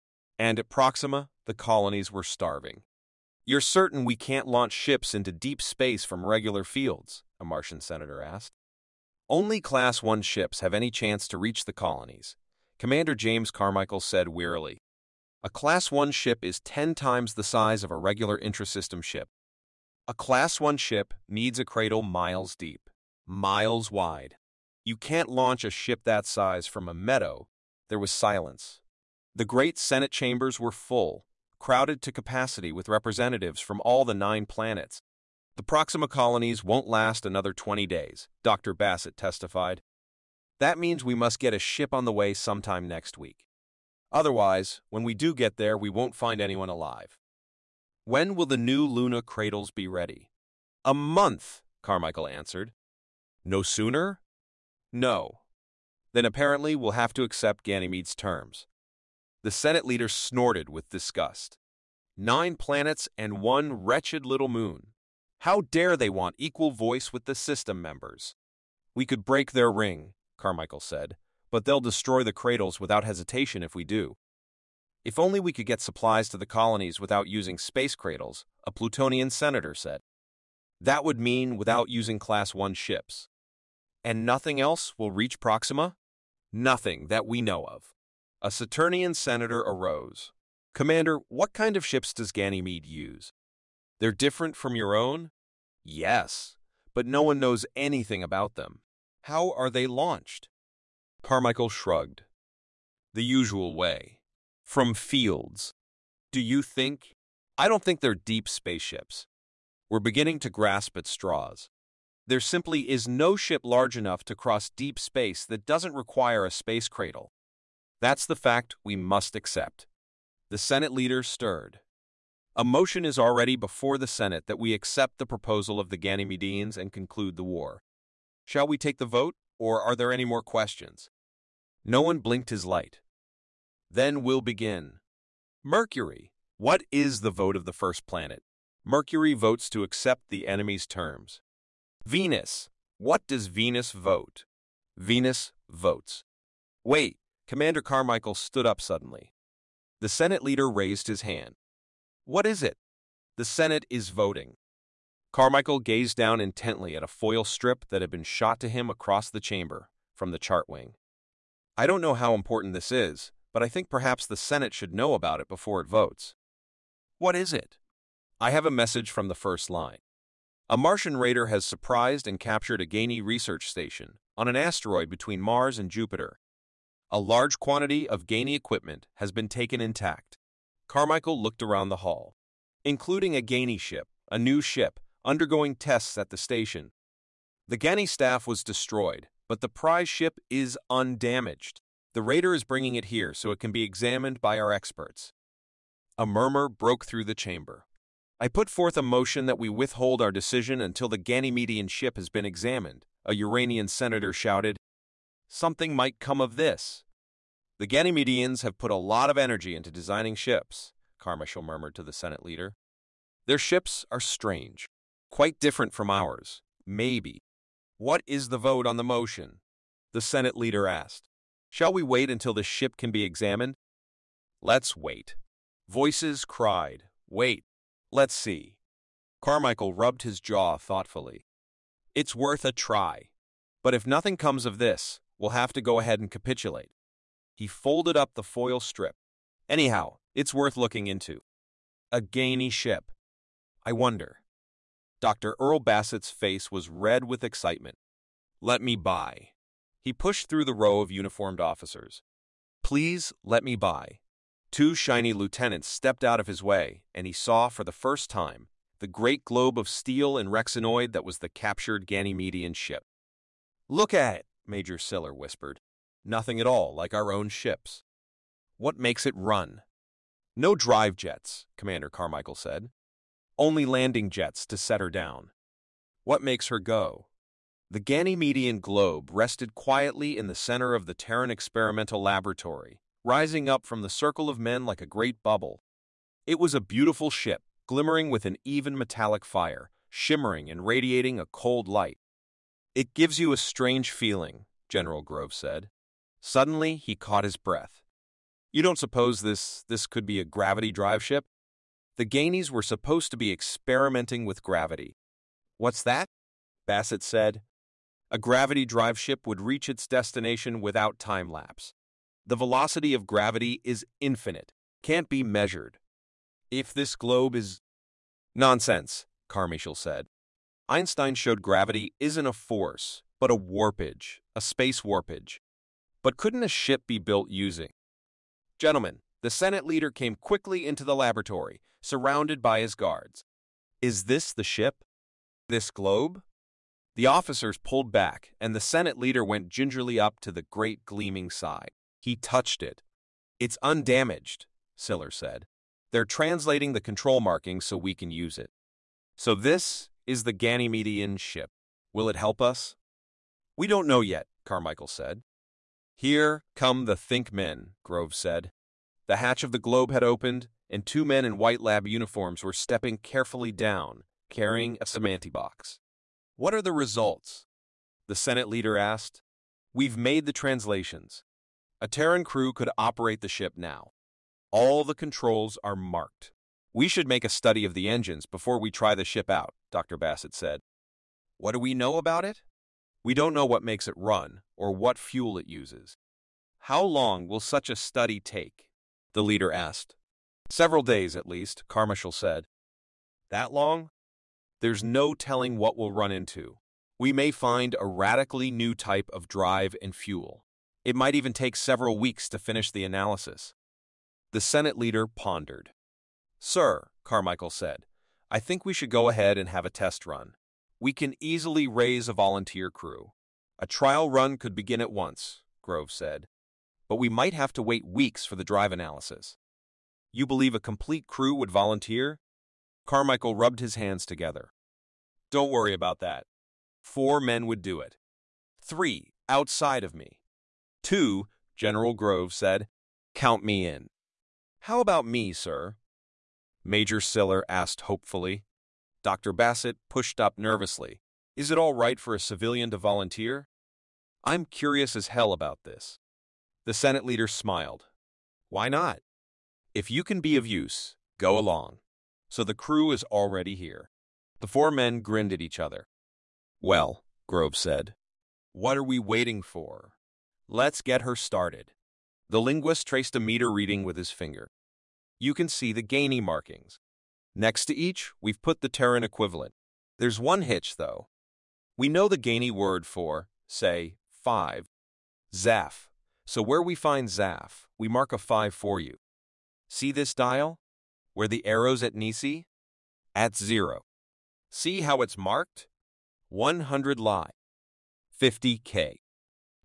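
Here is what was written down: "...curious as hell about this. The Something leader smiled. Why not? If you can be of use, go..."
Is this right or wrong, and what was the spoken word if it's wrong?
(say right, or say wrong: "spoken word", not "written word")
wrong: "Senate", not "Something".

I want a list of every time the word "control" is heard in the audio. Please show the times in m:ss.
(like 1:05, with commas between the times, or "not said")
5:47, 6:15.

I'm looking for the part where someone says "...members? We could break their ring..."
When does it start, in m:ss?
1:07.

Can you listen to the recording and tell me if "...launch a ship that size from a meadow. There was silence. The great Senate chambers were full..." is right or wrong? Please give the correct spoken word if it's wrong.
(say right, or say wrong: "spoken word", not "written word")
right.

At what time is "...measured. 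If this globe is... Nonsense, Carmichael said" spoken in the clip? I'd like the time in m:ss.
5:15.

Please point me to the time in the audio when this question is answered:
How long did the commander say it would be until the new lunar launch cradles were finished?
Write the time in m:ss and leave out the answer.
0:50.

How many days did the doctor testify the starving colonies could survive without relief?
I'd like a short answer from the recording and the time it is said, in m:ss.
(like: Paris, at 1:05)
20, at 0:37.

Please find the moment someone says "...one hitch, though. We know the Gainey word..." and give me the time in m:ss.
7:50.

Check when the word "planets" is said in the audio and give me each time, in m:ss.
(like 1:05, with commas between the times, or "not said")
0:34, 1:02, 2:18.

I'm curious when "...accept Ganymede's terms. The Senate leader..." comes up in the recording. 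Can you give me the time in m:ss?
0:57.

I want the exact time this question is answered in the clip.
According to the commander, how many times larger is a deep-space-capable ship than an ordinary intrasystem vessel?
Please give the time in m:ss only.
0:16.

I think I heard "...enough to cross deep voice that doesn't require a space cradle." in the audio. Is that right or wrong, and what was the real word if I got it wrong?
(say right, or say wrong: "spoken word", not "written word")
wrong: "space", not "voice".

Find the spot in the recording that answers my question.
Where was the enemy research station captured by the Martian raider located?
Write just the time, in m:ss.
2:54.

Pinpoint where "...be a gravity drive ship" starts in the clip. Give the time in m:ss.
5:00.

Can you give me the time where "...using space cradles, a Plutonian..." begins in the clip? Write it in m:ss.
1:17.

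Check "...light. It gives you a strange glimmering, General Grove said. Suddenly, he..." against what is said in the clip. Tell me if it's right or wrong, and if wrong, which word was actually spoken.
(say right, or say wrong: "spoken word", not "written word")
wrong: "feeling", not "glimmering".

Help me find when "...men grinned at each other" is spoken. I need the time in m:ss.
7:34.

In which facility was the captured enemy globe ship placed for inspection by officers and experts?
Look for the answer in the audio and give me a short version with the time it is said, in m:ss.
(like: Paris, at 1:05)
Terran Experimental Laboratory, at 4:41.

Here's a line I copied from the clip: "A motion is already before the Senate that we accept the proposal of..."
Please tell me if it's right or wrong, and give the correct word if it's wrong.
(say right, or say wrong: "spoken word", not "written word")
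right.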